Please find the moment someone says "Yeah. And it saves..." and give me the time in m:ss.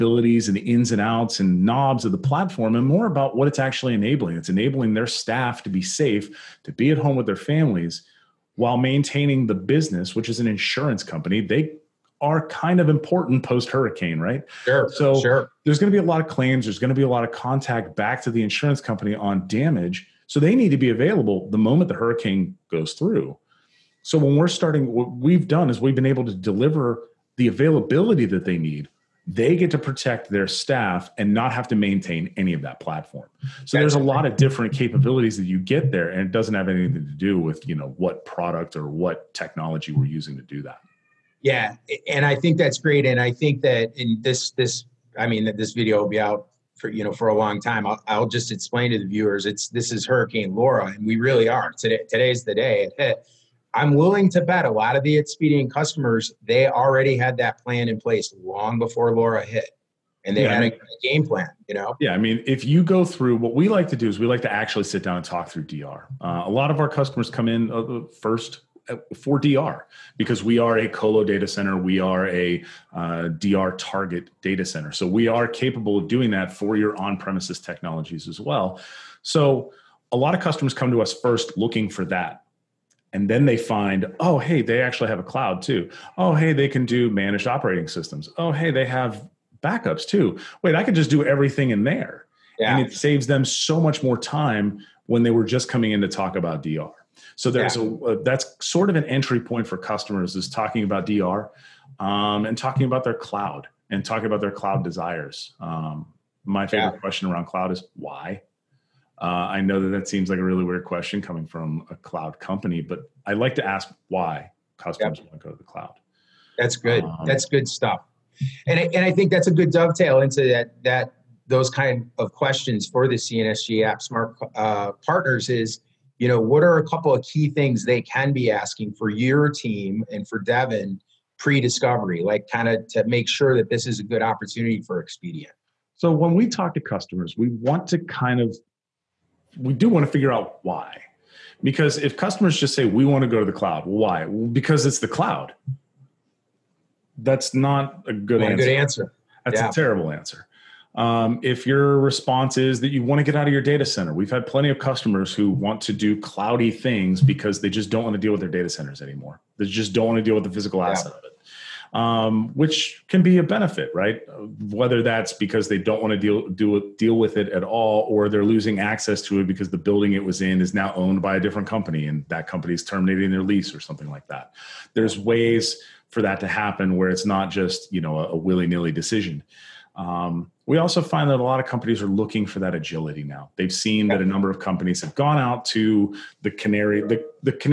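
1:32.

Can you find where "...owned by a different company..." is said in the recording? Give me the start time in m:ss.
2:50.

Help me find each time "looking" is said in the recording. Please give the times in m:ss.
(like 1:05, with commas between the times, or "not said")
1:21, 3:02.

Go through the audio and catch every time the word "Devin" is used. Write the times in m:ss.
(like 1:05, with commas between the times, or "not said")
2:10.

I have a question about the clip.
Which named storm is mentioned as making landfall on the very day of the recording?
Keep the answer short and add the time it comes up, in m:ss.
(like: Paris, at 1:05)
Hurricane Laura, at 0:50.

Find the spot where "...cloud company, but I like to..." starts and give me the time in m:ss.
1:51.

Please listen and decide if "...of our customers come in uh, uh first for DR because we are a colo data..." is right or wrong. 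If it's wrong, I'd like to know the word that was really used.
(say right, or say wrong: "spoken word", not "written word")
right.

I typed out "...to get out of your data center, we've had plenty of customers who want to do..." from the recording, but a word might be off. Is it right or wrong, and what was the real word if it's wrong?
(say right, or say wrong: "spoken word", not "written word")
right.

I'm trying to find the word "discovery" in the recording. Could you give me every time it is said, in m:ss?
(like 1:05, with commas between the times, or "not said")
2:11.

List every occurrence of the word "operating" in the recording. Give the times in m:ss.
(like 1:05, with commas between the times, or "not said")
1:27.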